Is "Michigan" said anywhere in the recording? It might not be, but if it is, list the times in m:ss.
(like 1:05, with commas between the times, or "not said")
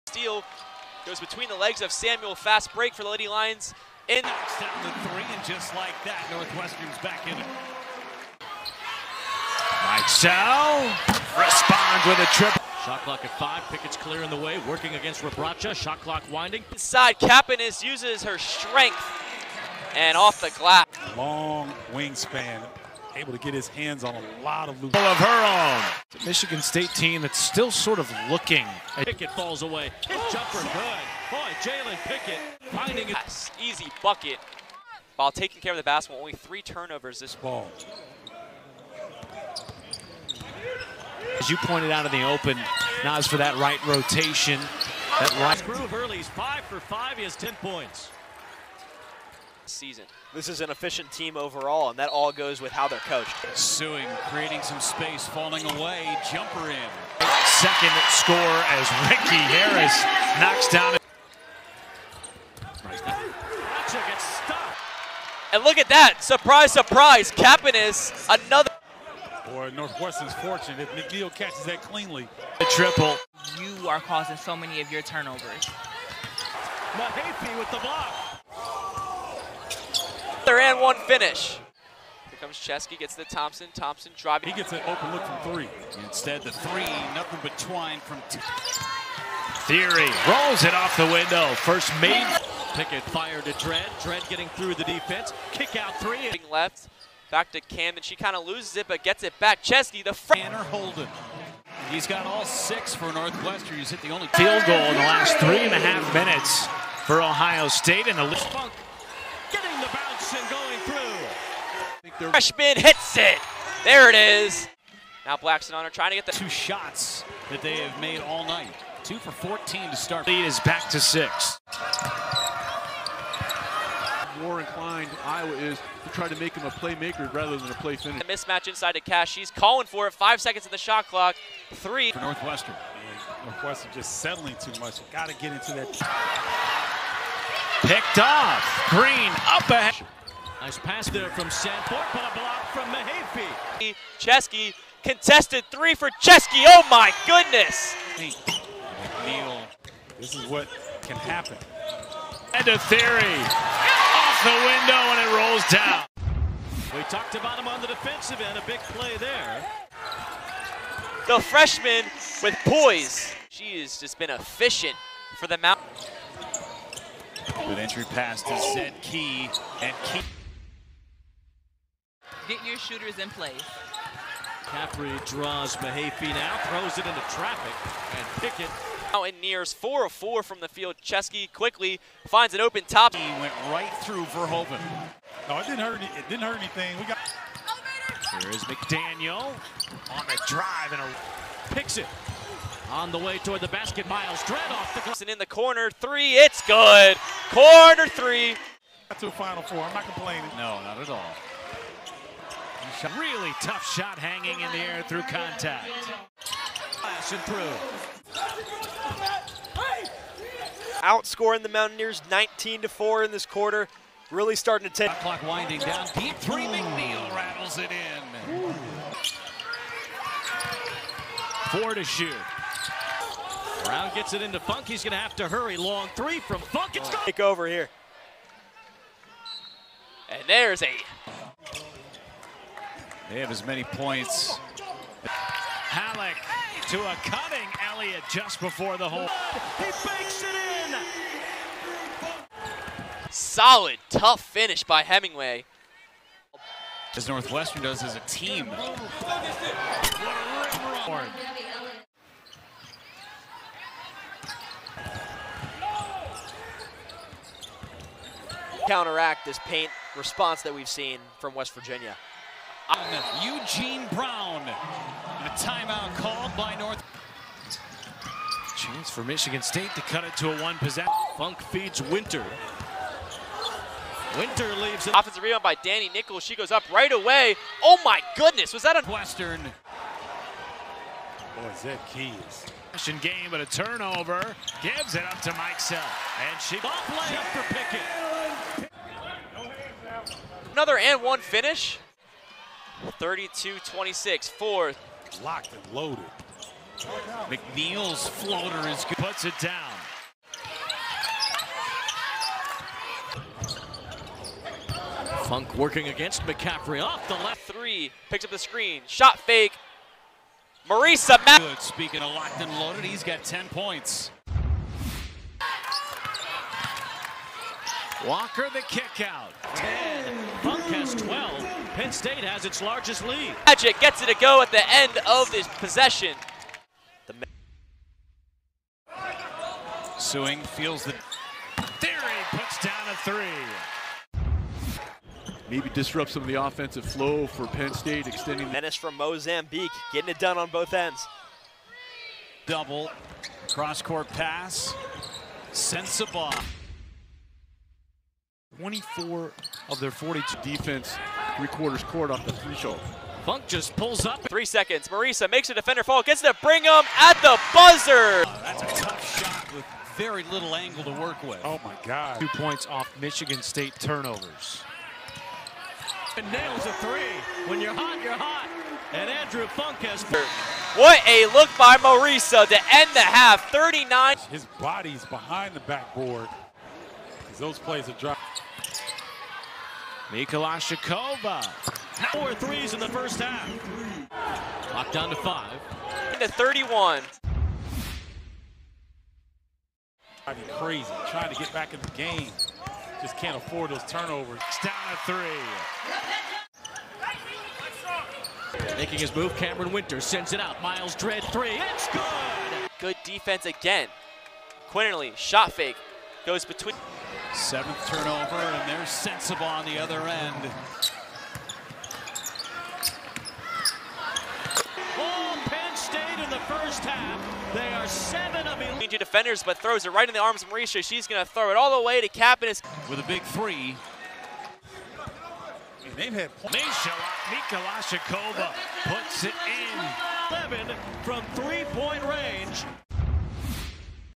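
0:26, 4:29, 6:03.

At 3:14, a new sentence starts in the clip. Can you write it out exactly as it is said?
Myles Dread off the glass and in the corner three.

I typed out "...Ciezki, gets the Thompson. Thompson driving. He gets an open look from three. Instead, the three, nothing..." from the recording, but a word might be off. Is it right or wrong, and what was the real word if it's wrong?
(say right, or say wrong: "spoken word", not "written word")
right.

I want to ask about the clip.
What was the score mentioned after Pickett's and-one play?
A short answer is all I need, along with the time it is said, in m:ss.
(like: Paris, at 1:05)
32-26, at 4:53.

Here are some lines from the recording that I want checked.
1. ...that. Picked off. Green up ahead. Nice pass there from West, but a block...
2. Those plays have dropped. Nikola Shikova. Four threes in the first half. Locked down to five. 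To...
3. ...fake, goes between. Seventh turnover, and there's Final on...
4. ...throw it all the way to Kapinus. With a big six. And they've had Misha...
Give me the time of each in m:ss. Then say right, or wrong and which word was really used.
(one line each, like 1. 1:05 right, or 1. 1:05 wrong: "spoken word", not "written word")
1. 2:15 wrong: "Sanford", not "West"
2. 6:17 right
3. 6:45 wrong: "Sensible", not "Final"
4. 7:01 wrong: "three", not "six".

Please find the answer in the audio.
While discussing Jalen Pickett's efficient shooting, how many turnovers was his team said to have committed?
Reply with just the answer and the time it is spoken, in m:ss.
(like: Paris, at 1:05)
3, at 0:36.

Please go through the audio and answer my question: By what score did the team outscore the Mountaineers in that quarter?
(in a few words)
19 to 4.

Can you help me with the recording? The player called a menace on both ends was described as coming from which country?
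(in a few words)
Mozambique.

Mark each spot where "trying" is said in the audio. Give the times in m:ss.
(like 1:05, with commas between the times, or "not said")
1:55, 6:31.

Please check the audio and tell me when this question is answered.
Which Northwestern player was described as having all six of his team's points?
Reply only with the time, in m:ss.
1:40.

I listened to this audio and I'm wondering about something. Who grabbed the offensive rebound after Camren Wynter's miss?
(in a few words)
Danny Nichols.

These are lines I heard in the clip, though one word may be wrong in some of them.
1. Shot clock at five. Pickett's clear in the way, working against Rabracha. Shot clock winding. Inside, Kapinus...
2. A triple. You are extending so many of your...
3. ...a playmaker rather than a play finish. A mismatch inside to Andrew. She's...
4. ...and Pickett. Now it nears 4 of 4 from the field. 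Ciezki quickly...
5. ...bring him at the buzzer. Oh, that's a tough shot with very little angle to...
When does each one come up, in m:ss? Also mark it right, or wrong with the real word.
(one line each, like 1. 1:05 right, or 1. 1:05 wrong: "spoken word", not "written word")
1. 0:12 right
2. 1:12 wrong: "causing", not "extending"
3. 2:06 wrong: "Cash", not "Andrew"
4. 2:58 right
5. 5:56 right.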